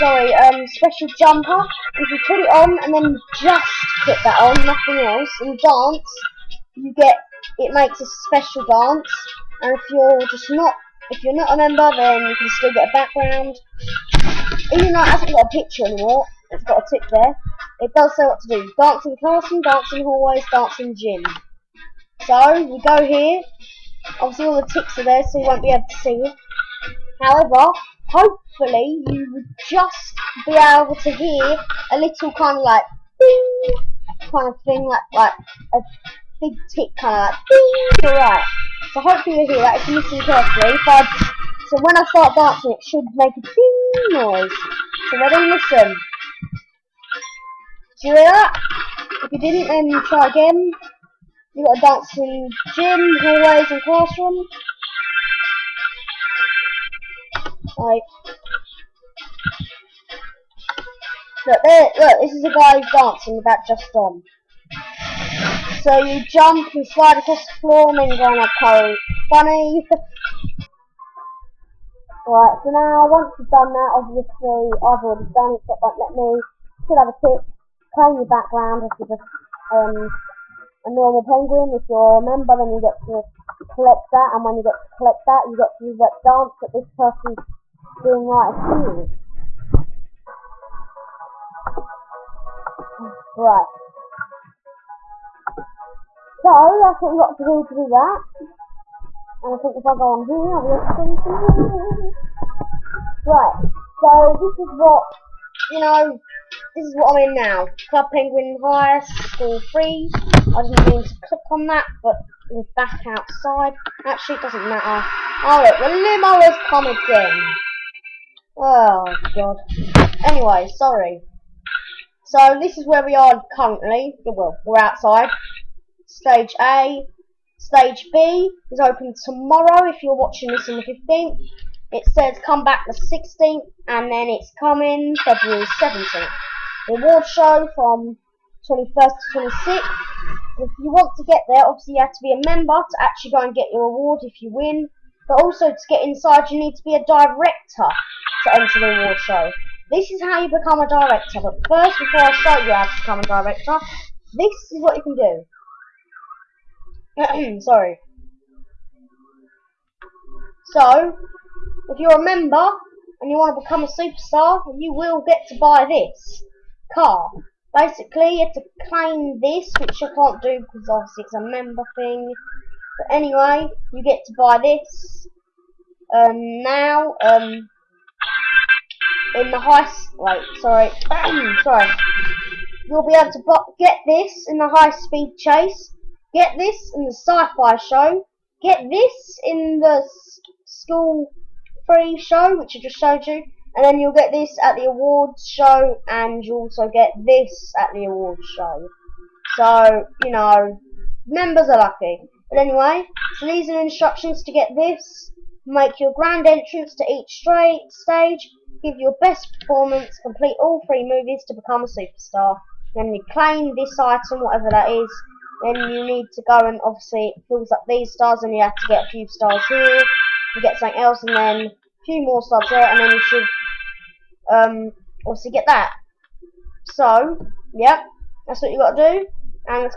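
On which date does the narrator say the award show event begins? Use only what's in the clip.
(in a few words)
21st.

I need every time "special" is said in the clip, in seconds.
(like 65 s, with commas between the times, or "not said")
0 s, 8 s.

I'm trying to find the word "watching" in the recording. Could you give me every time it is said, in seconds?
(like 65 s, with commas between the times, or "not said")
130 s.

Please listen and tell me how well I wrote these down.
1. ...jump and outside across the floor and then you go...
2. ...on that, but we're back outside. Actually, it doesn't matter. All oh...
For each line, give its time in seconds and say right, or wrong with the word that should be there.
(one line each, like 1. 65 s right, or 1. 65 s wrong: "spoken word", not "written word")
1. 66 s wrong: "slide", not "outside"
2. 111 s right.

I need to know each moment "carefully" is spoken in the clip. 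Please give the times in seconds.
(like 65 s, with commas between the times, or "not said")
40 s.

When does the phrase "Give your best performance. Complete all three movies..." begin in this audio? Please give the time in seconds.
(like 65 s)
208 s.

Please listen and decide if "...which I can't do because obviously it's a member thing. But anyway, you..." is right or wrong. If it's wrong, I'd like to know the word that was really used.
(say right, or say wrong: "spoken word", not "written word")
right.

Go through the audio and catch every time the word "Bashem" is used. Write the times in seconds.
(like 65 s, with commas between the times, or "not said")
not said.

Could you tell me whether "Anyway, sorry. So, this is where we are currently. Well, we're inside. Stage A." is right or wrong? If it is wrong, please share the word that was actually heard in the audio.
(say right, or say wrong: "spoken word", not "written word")
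wrong: "outside", not "inside".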